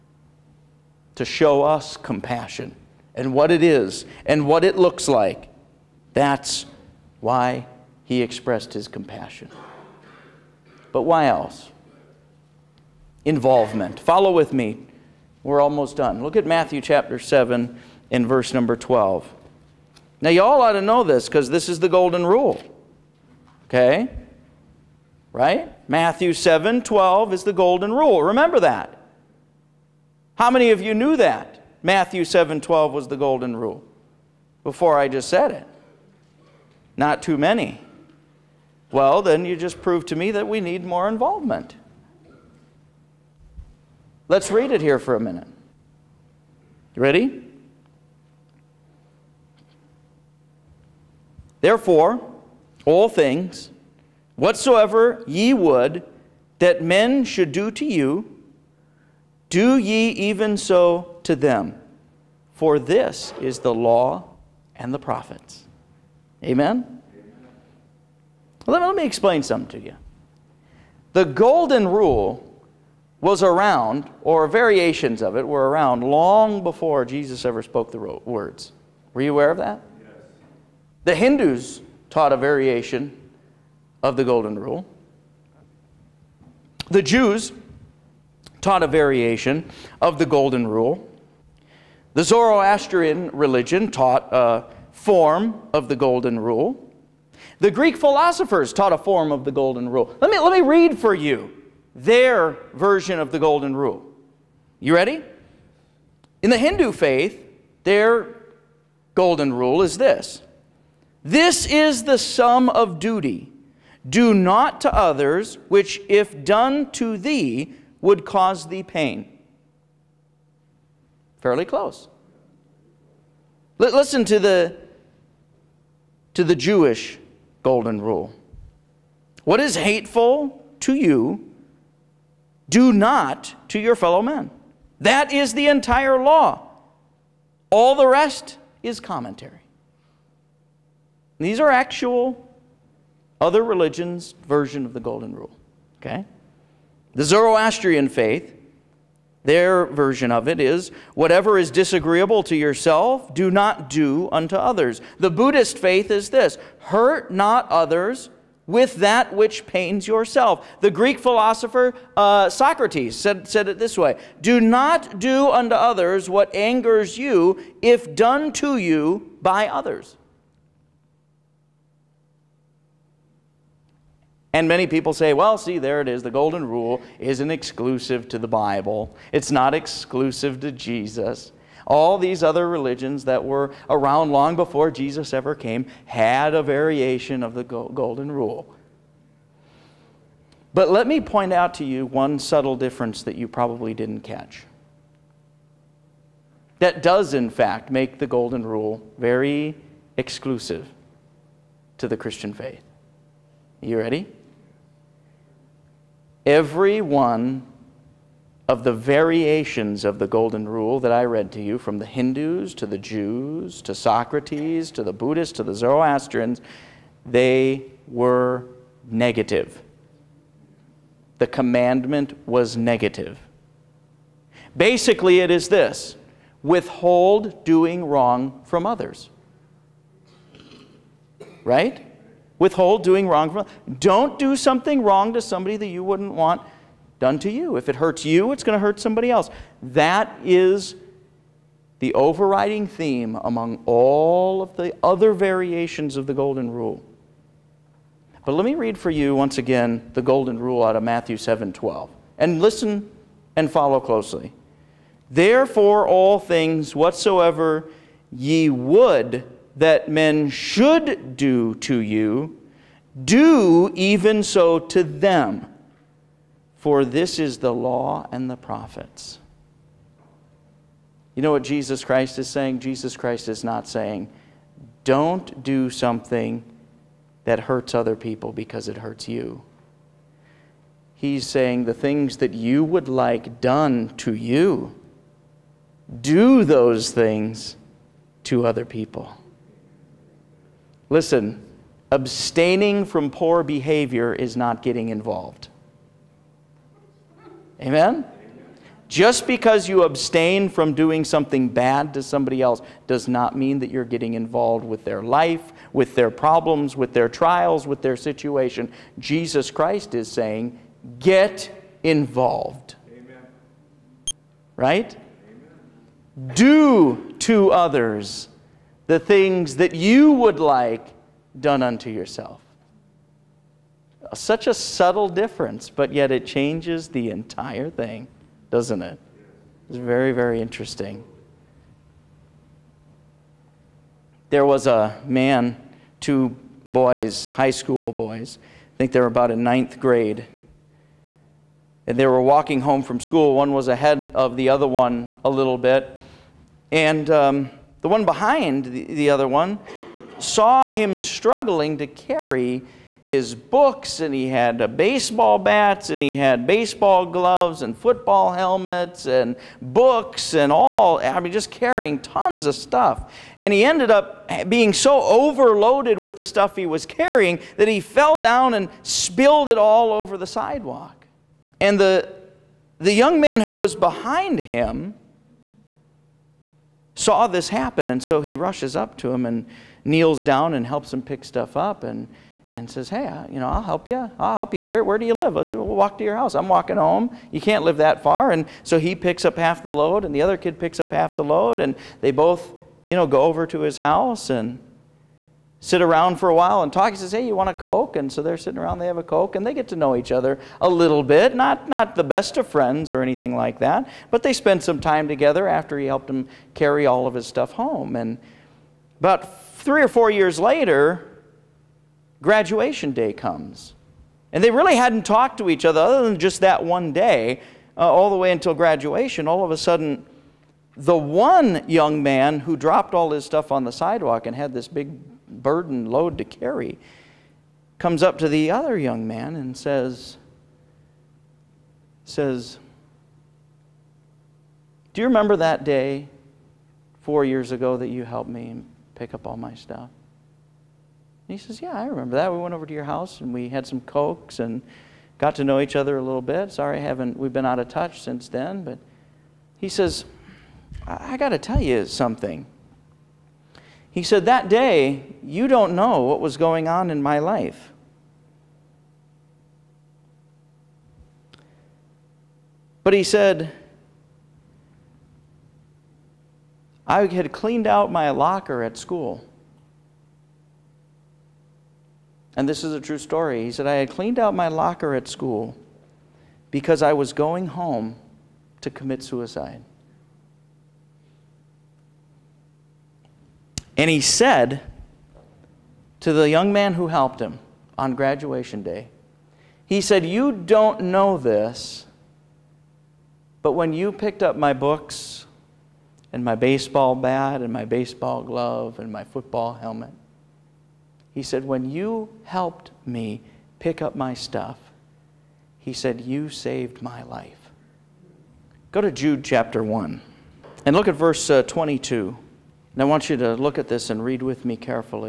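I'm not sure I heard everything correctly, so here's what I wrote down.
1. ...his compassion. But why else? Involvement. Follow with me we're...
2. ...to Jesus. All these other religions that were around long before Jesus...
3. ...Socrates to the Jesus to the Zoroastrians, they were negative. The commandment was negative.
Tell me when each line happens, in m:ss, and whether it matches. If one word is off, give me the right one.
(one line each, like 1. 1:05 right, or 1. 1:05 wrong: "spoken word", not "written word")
1. 0:08 right
2. 3:00 right
3. 3:33 wrong: "Buddhists", not "Jesus".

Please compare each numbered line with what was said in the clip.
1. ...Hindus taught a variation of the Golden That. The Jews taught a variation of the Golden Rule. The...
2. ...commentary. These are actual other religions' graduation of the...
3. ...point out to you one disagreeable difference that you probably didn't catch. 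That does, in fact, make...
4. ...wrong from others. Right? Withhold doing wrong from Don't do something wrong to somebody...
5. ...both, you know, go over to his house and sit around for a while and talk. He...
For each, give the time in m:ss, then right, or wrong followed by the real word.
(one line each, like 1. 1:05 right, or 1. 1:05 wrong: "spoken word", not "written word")
1. 1:21 wrong: "Rule", not "That"
2. 2:19 wrong: "version", not "graduation"
3. 3:11 wrong: "subtle", not "disagreeable"
4. 3:48 right
5. 6:32 right.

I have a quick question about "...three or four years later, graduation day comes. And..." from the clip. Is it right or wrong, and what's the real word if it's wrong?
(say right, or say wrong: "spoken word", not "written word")
right.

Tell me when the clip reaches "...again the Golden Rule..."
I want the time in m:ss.
4:09.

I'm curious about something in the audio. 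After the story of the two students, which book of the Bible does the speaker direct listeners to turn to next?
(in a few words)
Jude.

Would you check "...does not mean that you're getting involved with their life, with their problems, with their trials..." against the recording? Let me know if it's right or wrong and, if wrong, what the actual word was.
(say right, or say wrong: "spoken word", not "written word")
right.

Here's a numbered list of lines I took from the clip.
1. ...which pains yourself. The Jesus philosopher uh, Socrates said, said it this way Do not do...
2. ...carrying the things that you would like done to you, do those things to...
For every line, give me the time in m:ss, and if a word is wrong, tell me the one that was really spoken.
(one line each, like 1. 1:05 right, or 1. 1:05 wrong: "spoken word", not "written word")
1. 2:39 wrong: "Greek", not "Jesus"
2. 4:41 wrong: "saying", not "carrying".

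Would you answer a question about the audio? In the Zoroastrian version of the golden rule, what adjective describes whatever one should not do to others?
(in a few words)
disagreeable.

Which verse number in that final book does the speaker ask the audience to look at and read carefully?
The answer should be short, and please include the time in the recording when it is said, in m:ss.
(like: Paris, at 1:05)
22, at 8:31.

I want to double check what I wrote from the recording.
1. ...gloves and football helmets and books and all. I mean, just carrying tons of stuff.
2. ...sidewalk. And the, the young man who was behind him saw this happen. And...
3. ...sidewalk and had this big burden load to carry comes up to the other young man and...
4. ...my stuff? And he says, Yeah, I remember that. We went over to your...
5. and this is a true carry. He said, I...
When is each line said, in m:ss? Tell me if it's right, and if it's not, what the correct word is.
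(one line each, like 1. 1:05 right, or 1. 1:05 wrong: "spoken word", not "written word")
1. 5:57 right
2. 6:10 right
3. 7:03 right
4. 7:19 right
5. 7:52 wrong: "story", not "carry".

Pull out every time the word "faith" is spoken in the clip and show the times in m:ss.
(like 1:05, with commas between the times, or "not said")
1:46, 2:28, 2:35, 3:22.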